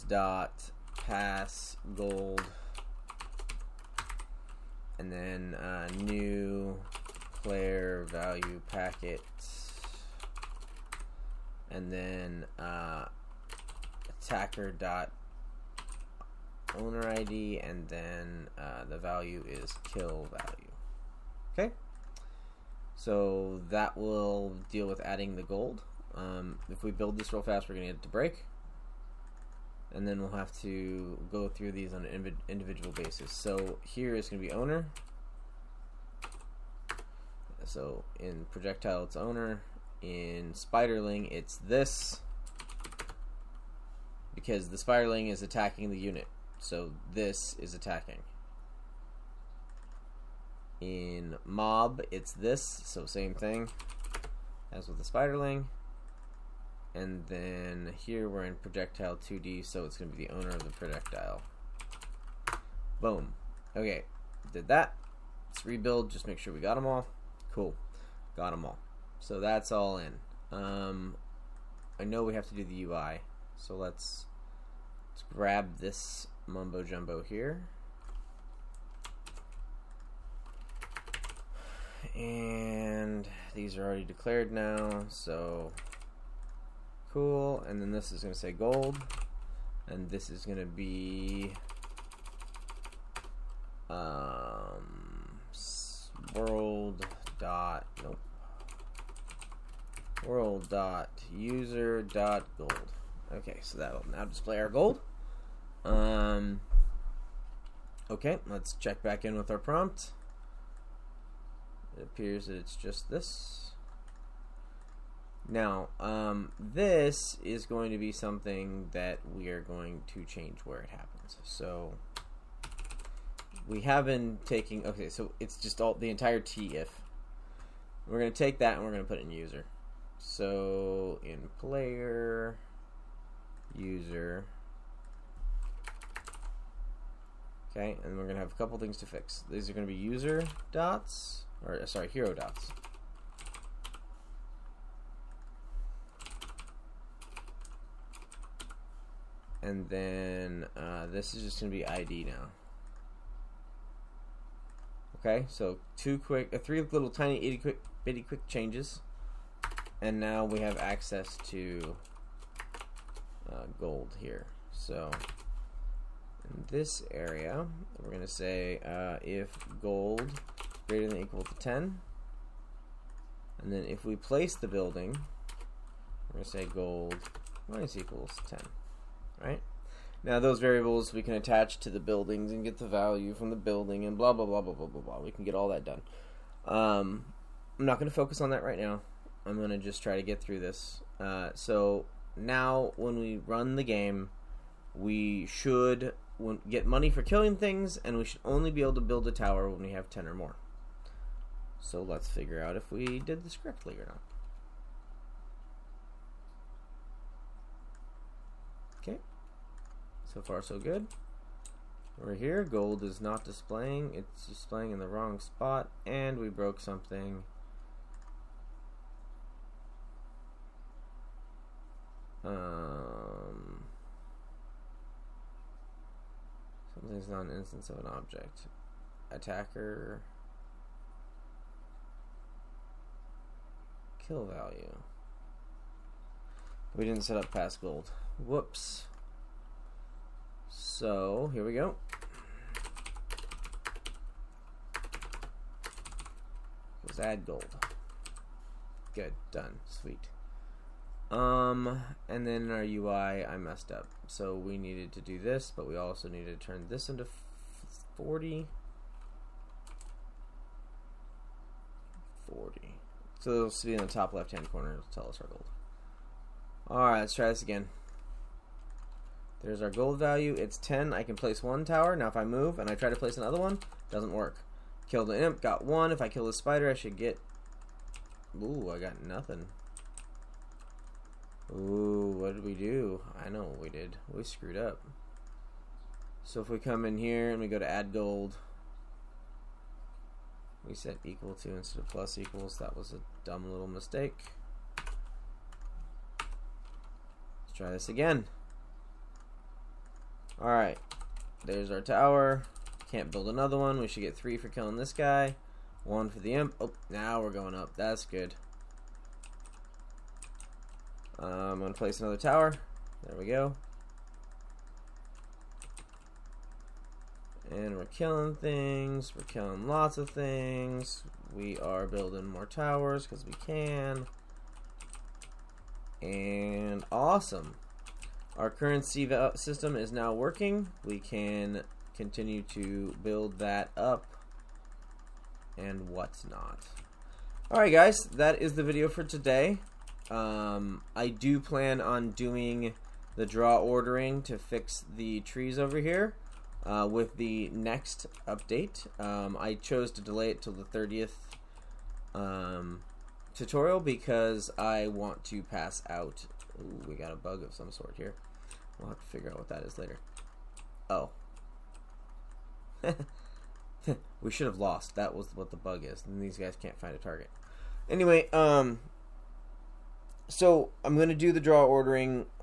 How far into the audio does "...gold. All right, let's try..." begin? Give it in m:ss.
4:25.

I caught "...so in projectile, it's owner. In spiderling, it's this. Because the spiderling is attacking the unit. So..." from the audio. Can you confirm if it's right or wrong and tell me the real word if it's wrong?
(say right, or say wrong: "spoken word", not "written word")
right.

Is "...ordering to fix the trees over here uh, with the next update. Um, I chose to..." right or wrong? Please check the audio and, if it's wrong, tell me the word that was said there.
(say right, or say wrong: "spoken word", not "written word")
right.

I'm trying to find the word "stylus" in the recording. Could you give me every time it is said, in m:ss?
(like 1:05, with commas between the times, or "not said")
not said.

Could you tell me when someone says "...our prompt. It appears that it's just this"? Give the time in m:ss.
1:49.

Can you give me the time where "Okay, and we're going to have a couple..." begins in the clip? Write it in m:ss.
2:17.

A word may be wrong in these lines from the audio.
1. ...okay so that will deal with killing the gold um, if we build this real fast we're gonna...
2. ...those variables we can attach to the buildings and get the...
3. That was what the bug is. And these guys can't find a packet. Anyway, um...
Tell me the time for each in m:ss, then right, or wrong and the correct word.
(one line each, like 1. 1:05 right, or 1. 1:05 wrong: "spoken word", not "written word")
1. 0:21 wrong: "adding", not "killing"
2. 3:00 right
3. 6:05 wrong: "target", not "packet".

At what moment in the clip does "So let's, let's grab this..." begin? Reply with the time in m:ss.
1:13.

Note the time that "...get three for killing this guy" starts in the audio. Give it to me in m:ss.
5:04.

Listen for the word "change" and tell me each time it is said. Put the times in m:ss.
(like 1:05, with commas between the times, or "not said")
2:00, 2:38.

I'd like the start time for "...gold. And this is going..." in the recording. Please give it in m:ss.
1:28.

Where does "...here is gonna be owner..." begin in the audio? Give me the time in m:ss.
0:33.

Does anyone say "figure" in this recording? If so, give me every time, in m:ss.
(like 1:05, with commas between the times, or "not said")
3:22, 5:59.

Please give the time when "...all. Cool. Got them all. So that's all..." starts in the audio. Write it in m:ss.
1:06.